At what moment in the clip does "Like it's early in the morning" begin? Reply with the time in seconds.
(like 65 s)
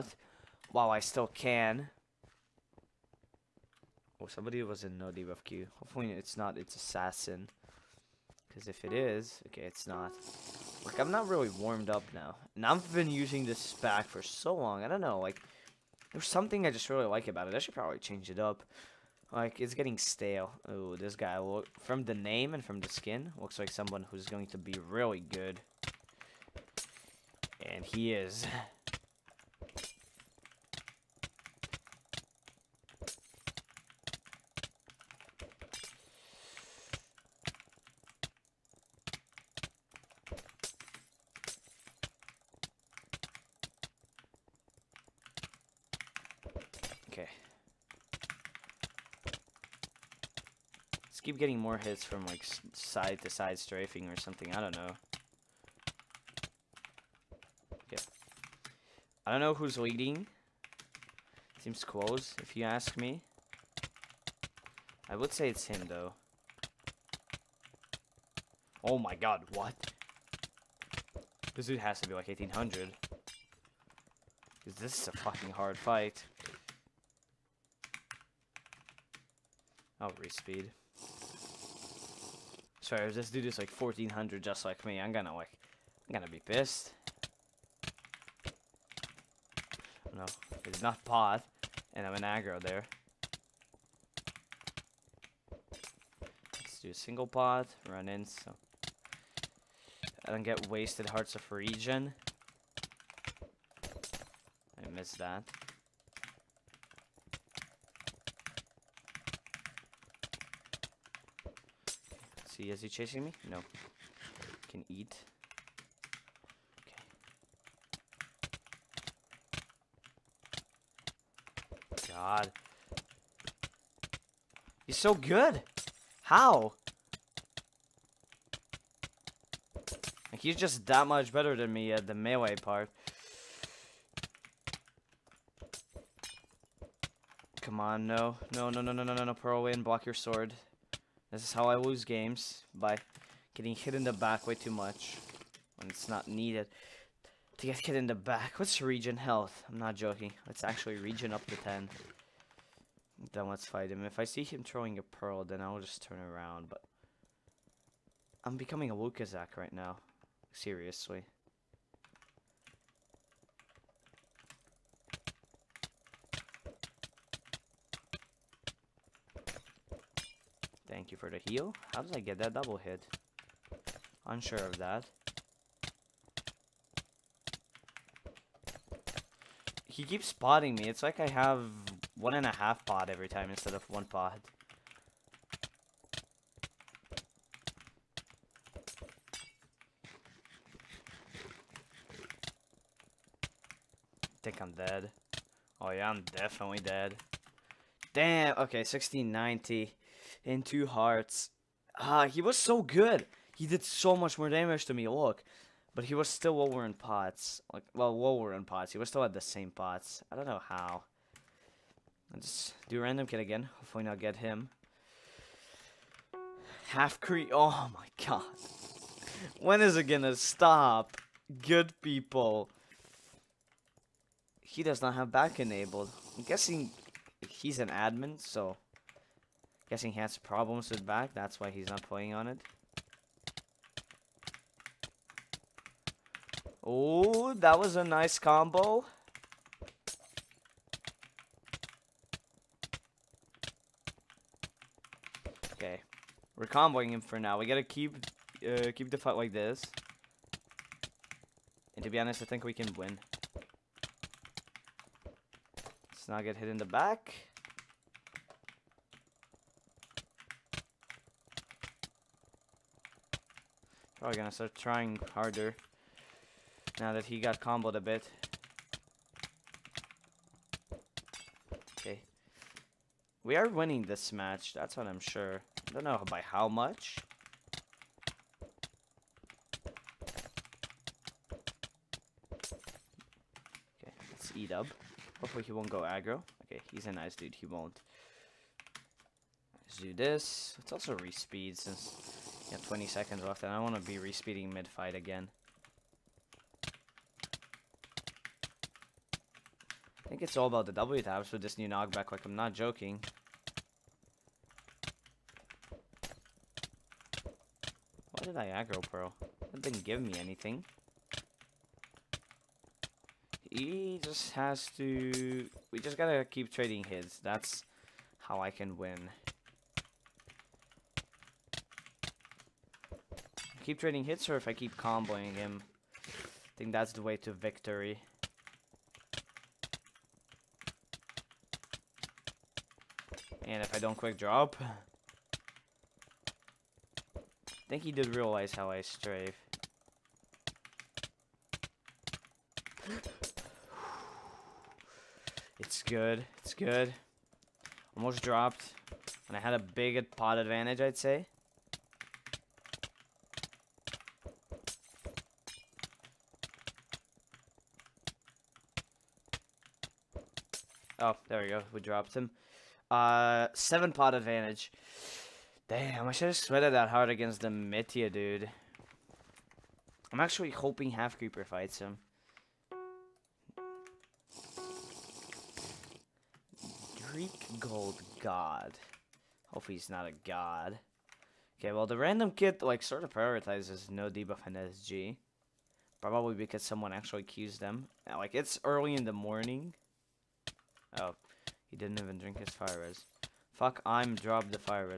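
388 s.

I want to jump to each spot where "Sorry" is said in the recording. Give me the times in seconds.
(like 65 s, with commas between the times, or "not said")
82 s.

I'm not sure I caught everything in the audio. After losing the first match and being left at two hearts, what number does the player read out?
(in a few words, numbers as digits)
1690.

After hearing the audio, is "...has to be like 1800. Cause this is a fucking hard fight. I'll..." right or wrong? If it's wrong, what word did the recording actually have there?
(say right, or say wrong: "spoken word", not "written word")
right.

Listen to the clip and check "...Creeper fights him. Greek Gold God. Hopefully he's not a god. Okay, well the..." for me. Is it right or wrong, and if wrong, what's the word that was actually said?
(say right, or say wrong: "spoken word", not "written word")
right.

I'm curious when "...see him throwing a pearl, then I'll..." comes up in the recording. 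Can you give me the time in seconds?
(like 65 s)
154 s.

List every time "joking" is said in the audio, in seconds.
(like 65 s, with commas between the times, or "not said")
149 s, 302 s.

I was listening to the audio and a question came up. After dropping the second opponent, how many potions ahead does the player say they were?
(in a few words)
7.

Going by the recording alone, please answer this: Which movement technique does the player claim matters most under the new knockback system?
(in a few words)
W taps.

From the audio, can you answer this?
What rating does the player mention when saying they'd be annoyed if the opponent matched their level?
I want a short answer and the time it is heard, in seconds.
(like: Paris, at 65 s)
1400, at 83 s.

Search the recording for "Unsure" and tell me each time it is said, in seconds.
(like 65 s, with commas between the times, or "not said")
174 s.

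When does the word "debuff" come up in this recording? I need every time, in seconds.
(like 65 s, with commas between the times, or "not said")
5 s, 384 s.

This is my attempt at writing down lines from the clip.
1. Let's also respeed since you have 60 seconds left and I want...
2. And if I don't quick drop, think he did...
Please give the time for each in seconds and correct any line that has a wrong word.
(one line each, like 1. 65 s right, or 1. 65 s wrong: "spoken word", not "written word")
1. 290 s wrong: "20", not "60"
2. 333 s right.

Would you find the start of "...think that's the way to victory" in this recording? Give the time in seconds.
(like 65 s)
326 s.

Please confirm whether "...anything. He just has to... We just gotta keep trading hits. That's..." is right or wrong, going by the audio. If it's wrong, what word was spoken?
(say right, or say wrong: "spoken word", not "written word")
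right.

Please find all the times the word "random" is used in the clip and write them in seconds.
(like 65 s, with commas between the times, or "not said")
213 s, 382 s.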